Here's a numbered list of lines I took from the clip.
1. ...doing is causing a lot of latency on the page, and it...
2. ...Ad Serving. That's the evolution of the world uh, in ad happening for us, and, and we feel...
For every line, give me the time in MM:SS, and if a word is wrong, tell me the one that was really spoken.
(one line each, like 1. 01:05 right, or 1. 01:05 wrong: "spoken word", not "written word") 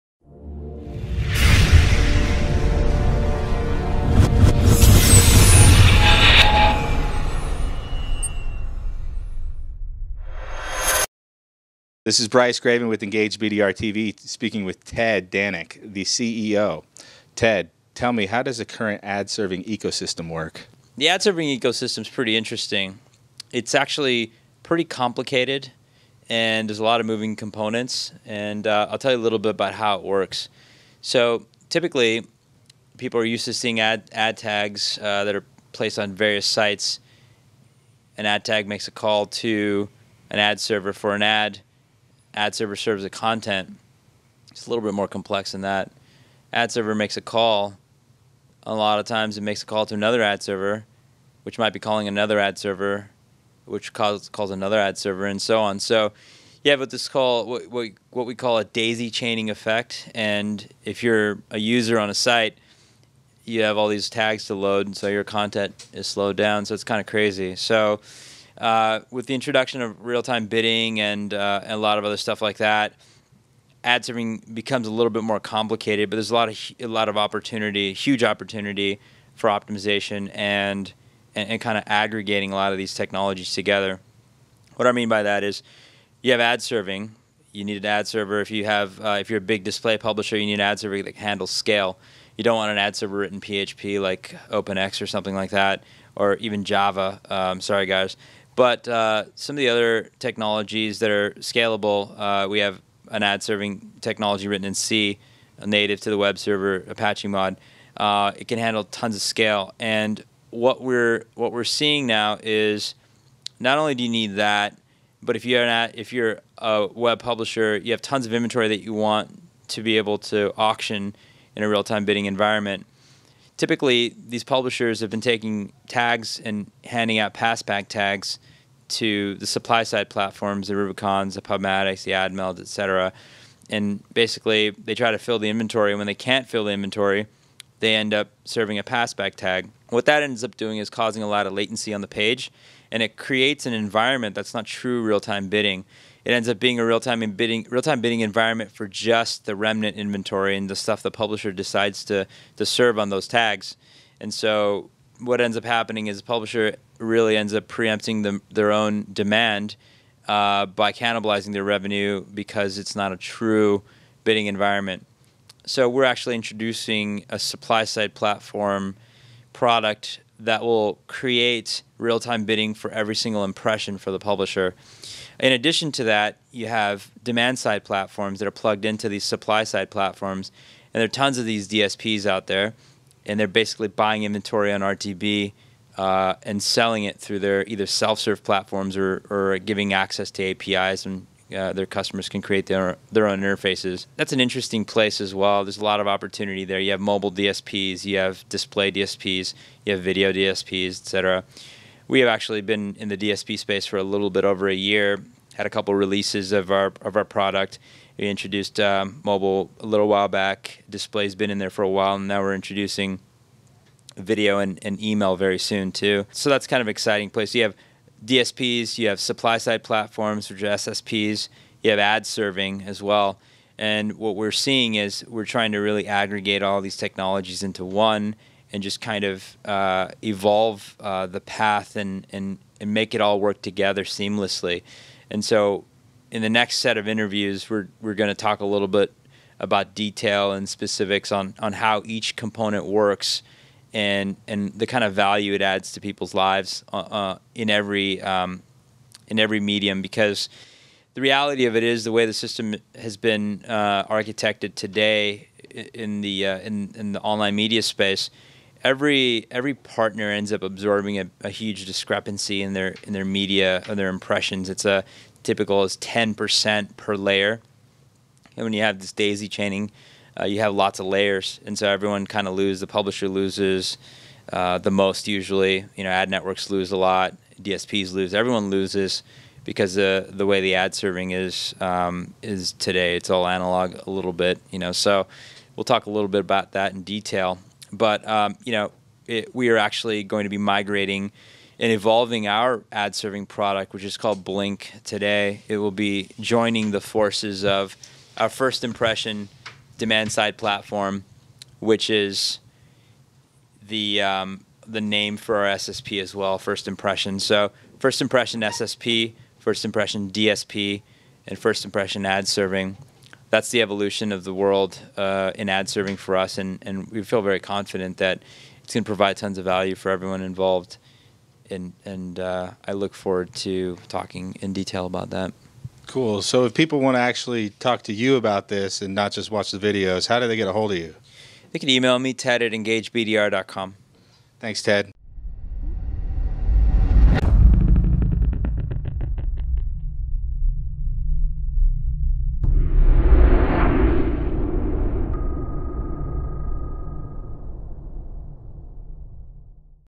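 1. 02:20 right
2. 05:12 wrong: "serving", not "happening".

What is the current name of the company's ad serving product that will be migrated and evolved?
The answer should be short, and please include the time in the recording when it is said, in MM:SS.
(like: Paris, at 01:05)
Blink, at 04:54.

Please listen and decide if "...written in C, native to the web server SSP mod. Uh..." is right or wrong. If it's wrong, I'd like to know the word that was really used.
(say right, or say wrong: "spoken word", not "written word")
wrong: "Apache", not "SSP".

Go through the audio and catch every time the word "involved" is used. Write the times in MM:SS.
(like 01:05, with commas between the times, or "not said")
05:20.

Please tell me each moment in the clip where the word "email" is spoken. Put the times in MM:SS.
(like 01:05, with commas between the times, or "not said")
03:35, 05:31.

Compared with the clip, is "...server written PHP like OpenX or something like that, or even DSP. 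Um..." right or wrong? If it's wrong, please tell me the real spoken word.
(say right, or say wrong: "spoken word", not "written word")
wrong: "Java", not "DSP".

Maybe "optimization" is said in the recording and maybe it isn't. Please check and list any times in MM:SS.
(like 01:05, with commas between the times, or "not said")
01:19.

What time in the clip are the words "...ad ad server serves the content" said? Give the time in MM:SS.
00:41.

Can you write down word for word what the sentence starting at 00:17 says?
Ted, tell me, how does the current ad serving ecosystem work?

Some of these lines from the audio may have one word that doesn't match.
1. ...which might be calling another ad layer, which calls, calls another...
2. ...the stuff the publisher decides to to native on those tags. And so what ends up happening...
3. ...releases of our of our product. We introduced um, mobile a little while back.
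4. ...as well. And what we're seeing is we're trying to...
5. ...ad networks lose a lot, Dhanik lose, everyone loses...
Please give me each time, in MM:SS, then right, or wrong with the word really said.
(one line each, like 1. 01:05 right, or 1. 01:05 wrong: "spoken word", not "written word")
1. 00:51 wrong: "server", not "layer"
2. 02:30 wrong: "serve", not "native"
3. 03:25 right
4. 03:42 right
5. 04:36 wrong: "DSPs", not "Dhanik".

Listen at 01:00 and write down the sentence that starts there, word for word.
And if you're a user on a site, you have all these tags to load, and so your content is slowed down.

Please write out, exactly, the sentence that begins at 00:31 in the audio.
So typically, people are used to seeing ad, ad tags uh, that are placed on various sites.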